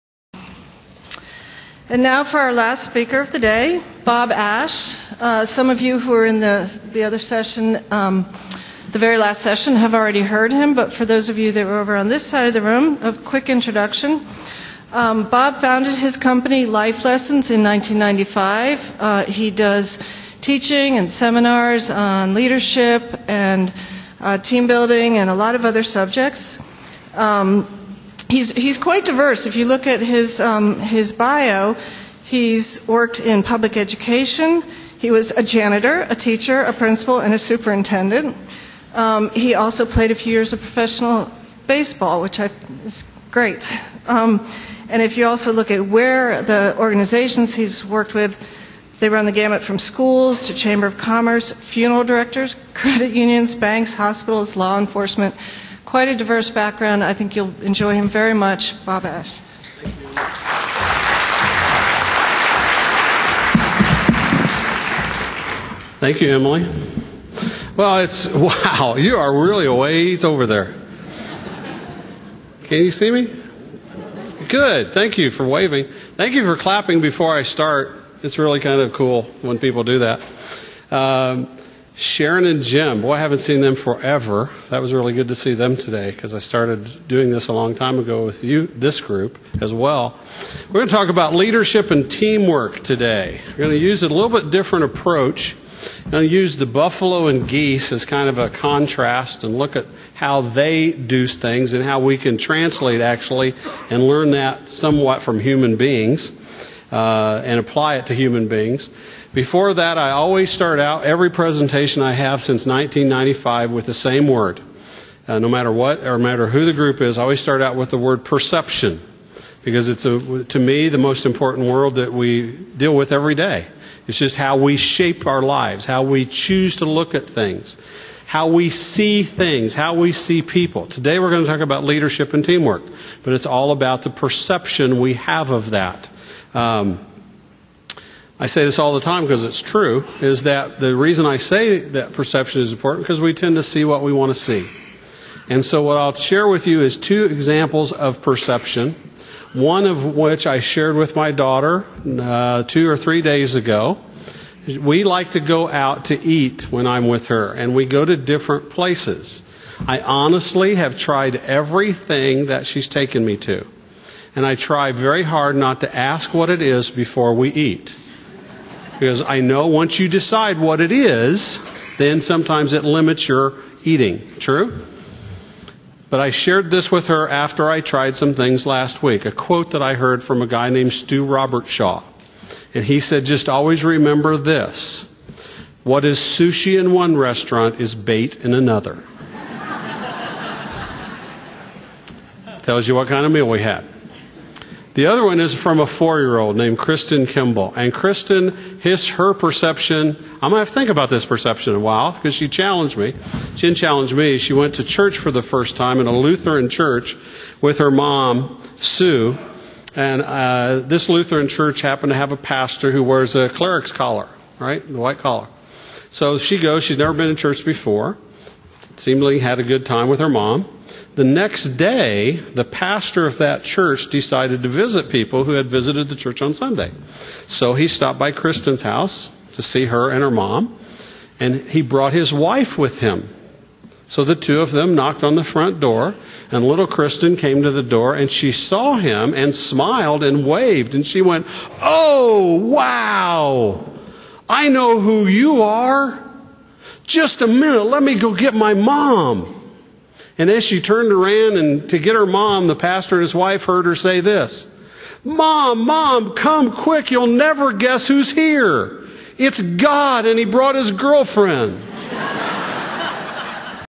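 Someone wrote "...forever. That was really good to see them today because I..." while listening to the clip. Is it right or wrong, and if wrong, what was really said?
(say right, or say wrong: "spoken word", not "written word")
right.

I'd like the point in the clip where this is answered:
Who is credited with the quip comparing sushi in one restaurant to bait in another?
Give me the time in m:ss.
3:00.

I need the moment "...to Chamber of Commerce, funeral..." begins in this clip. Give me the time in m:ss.
0:50.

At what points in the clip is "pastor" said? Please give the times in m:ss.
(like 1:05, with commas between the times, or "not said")
3:32, 3:42, 4:12.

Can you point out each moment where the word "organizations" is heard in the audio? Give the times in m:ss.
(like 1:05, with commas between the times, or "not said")
0:46.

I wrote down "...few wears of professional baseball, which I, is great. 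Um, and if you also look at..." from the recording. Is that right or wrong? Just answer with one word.
wrong.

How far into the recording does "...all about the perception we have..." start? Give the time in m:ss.
2:13.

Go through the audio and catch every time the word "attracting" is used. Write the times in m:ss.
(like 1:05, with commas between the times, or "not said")
not said.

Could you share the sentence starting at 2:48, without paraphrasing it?
Because I know once you decide what it is, then sometimes it limits your eating.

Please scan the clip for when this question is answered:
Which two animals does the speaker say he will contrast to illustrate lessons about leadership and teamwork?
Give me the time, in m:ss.
1:36.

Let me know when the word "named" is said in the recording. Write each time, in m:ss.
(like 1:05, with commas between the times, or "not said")
3:00, 3:16.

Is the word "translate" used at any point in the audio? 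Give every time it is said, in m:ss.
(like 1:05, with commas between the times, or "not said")
1:42.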